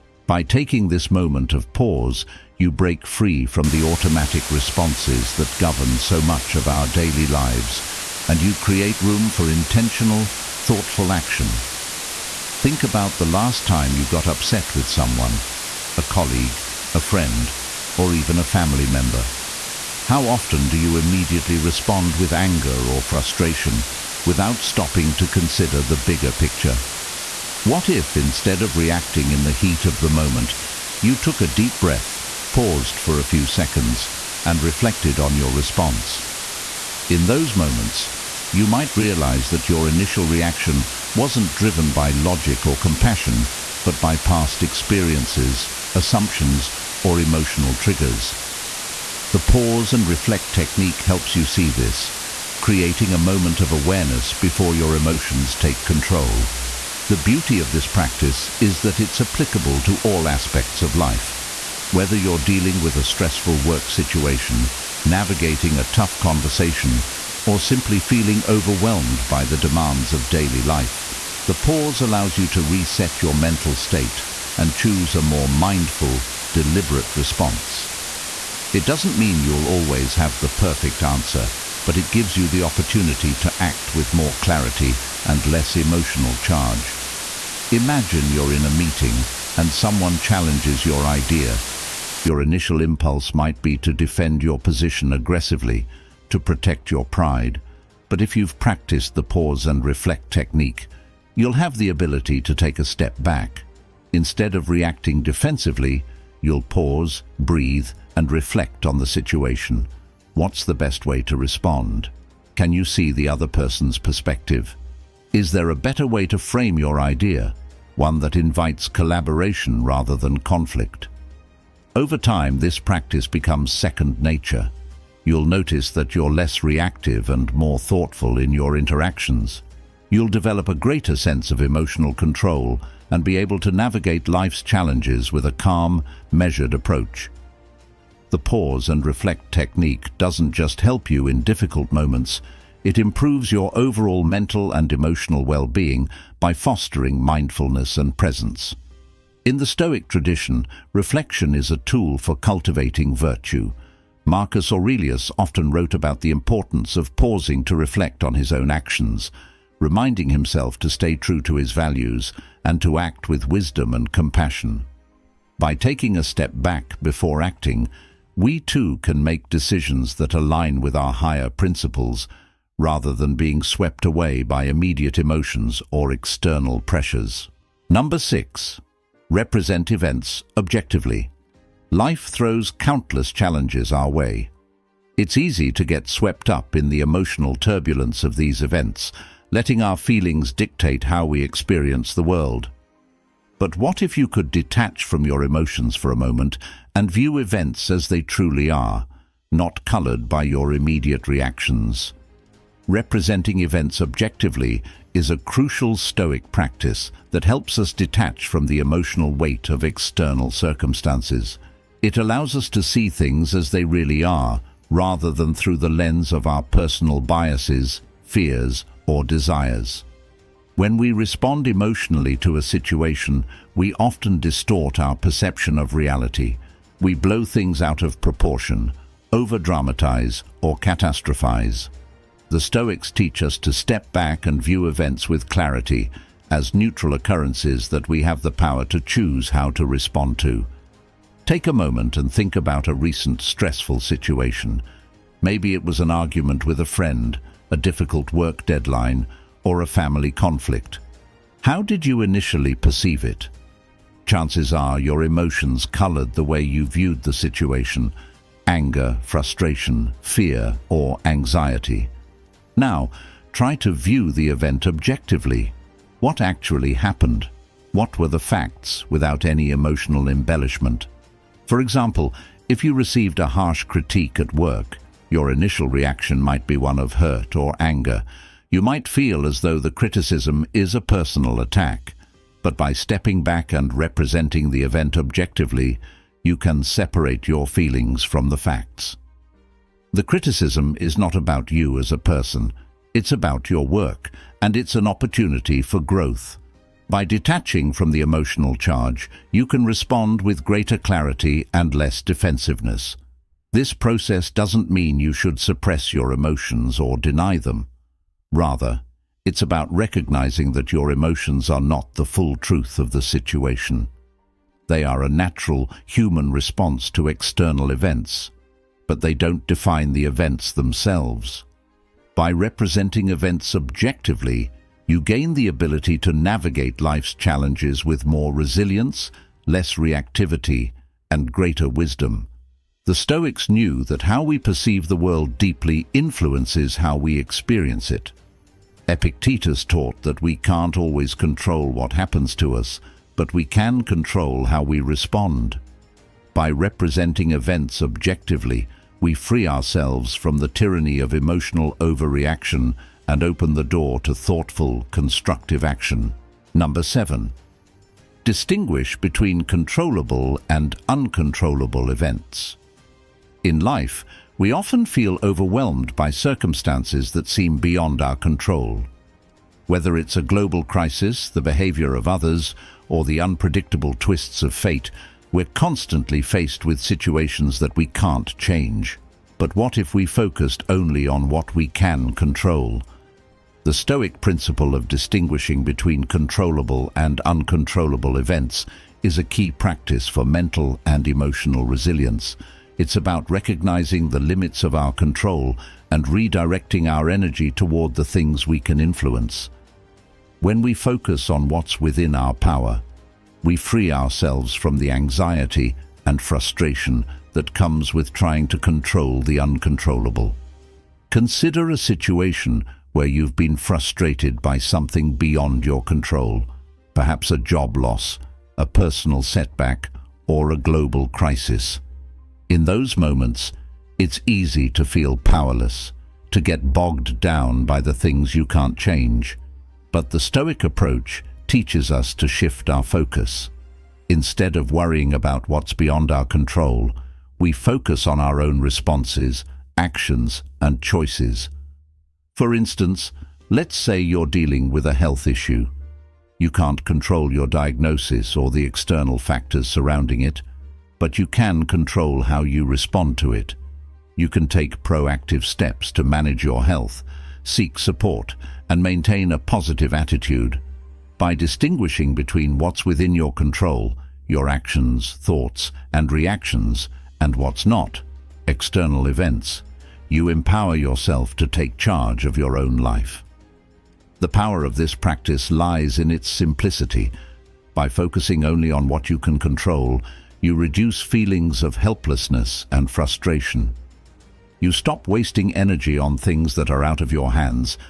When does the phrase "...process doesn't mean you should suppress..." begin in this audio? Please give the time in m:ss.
5:03.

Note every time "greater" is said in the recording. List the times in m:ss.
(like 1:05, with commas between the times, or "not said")
2:10, 5:00, 5:31.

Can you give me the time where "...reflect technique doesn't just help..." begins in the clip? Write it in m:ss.
2:19.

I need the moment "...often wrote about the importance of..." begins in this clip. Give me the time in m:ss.
2:35.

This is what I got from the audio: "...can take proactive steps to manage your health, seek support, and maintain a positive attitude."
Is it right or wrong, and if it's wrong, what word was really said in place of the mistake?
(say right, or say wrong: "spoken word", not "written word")
right.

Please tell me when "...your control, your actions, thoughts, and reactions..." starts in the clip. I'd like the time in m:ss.
7:43.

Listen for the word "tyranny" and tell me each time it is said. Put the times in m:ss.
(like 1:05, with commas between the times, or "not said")
5:50.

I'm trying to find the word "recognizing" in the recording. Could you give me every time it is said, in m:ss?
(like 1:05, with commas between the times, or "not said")
5:09, 6:33.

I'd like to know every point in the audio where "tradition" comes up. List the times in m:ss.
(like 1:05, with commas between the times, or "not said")
2:30.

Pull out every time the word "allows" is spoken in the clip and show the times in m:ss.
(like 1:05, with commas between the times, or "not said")
1:11, 3:32.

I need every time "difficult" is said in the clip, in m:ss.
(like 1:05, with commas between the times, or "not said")
2:21, 4:07.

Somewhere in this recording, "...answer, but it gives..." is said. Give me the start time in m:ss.
1:21.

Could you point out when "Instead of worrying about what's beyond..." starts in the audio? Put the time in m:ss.
7:14.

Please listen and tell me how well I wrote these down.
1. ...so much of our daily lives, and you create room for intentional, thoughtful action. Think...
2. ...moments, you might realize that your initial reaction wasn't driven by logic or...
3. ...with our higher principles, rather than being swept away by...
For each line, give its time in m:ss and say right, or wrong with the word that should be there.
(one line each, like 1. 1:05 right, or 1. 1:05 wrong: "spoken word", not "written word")
1. 0:05 right
2. 0:37 right
3. 2:50 right.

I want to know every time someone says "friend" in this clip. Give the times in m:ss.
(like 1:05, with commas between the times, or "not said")
0:16, 4:06.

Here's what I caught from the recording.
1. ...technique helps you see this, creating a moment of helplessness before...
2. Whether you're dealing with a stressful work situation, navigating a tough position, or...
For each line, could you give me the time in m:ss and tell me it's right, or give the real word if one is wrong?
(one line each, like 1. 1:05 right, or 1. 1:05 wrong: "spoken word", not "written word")
1. 0:50 wrong: "awareness", not "helplessness"
2. 1:01 wrong: "conversation", not "position".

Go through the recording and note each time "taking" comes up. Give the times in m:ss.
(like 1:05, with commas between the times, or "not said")
0:00, 2:45.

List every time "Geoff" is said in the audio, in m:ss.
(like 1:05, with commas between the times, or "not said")
not said.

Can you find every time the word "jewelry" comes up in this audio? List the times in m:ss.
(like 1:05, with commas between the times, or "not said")
not said.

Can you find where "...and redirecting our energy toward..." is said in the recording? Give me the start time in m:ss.
6:36.